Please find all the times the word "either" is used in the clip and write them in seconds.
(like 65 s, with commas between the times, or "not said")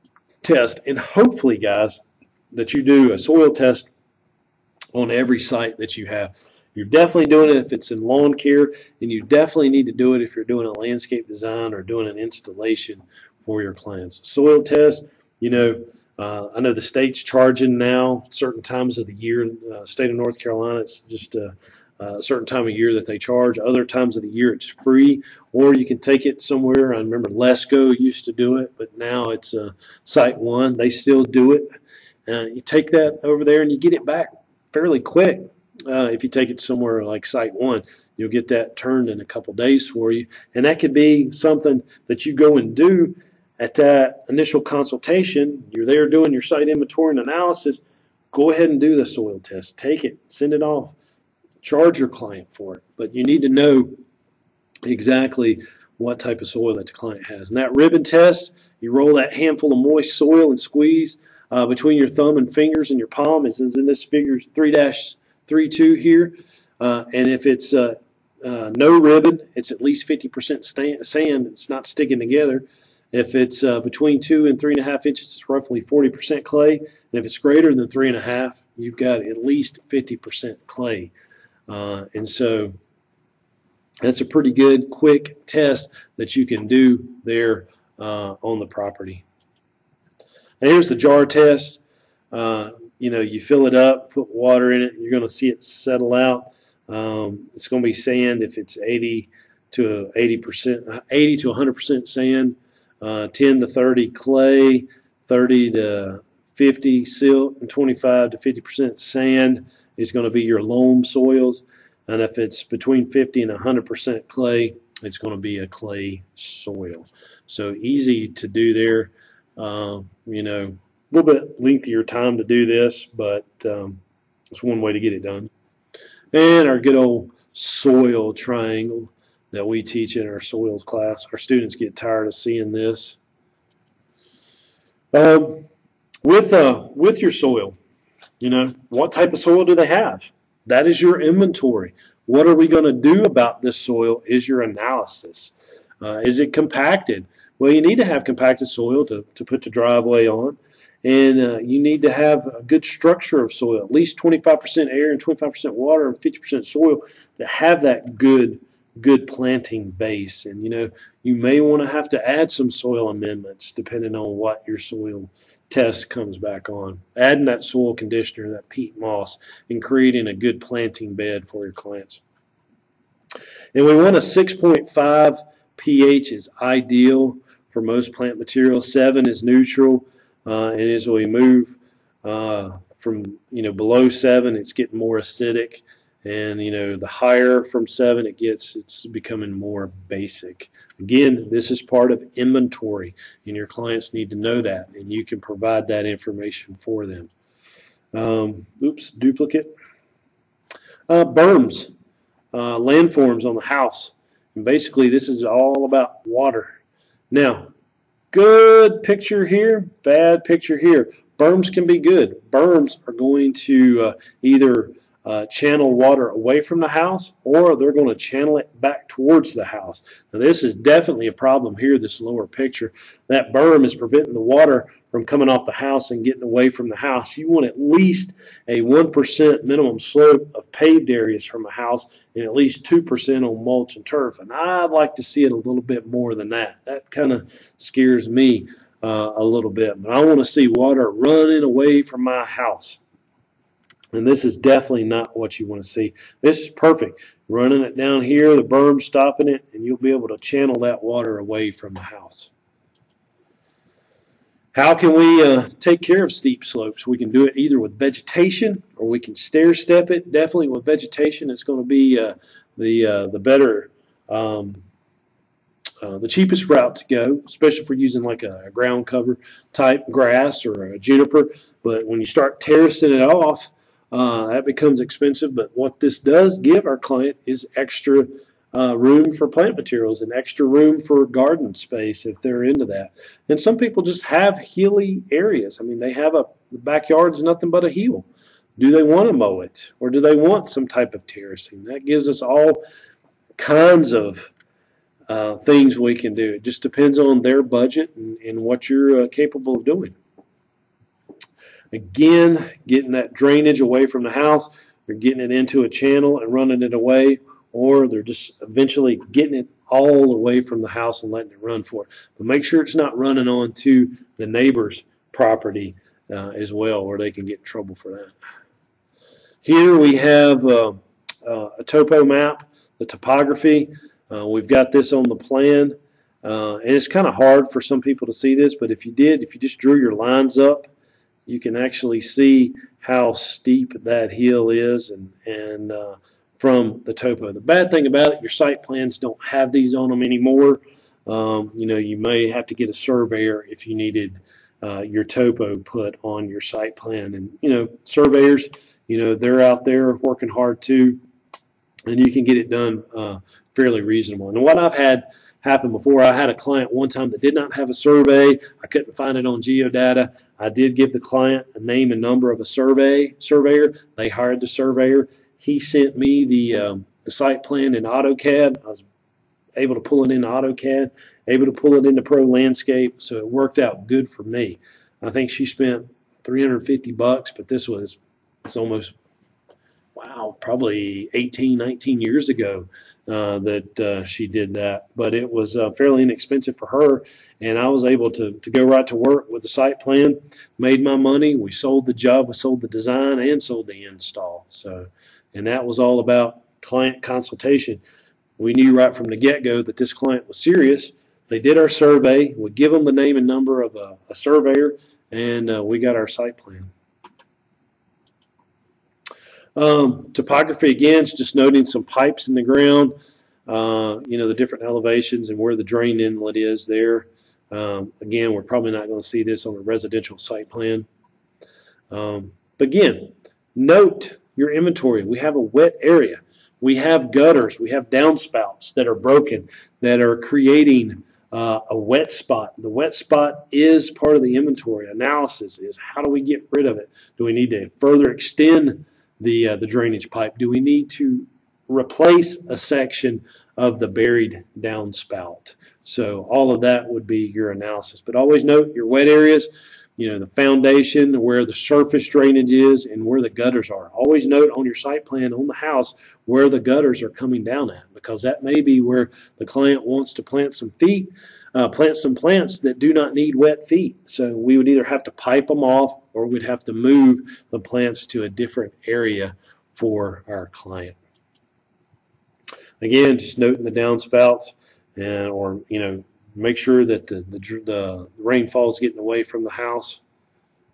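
214 s, 257 s, 464 s.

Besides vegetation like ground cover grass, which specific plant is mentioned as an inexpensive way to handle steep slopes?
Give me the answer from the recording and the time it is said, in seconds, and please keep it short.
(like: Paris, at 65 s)
Juniper, at 270 s.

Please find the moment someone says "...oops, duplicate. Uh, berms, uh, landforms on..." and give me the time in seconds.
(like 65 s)
198 s.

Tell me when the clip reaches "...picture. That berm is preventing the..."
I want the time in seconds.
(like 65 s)
222 s.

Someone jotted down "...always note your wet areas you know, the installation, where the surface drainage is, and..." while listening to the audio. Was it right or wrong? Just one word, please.
wrong.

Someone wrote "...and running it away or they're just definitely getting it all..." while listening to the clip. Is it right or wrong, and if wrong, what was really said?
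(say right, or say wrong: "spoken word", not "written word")
wrong: "eventually", not "definitely".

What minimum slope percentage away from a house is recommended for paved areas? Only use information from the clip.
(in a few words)
1%.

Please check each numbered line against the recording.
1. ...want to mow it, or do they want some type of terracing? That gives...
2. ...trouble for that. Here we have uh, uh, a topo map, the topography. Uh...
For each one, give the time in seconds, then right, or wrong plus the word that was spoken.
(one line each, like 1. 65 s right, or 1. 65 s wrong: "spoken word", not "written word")
1. 289 s right
2. 317 s right.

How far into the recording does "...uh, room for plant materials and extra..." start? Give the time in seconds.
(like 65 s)
278 s.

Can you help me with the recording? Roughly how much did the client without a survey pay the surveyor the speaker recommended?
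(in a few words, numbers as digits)
$350.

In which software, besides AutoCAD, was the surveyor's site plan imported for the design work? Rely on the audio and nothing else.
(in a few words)
Pro Landscape.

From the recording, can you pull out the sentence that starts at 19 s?
Uh, state of North Carolina, it's just a, uh, uh, a, certain time of year that they charge.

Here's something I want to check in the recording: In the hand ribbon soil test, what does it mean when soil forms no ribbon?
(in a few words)
At least 50% sand.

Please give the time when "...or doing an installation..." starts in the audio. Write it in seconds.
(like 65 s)
11 s.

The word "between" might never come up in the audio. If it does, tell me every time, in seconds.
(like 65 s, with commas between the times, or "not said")
61 s, 73 s, 112 s.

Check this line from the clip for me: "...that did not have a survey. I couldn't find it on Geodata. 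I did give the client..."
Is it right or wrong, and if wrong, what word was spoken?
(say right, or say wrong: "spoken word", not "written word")
right.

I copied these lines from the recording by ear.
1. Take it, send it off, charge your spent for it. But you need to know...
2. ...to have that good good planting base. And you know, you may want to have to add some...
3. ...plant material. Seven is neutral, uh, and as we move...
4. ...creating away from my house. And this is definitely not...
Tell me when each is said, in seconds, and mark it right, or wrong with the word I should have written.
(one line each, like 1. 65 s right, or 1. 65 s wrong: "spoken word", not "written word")
1. 49 s wrong: "client", not "spent"
2. 157 s right
3. 178 s right
4. 241 s wrong: "running", not "creating".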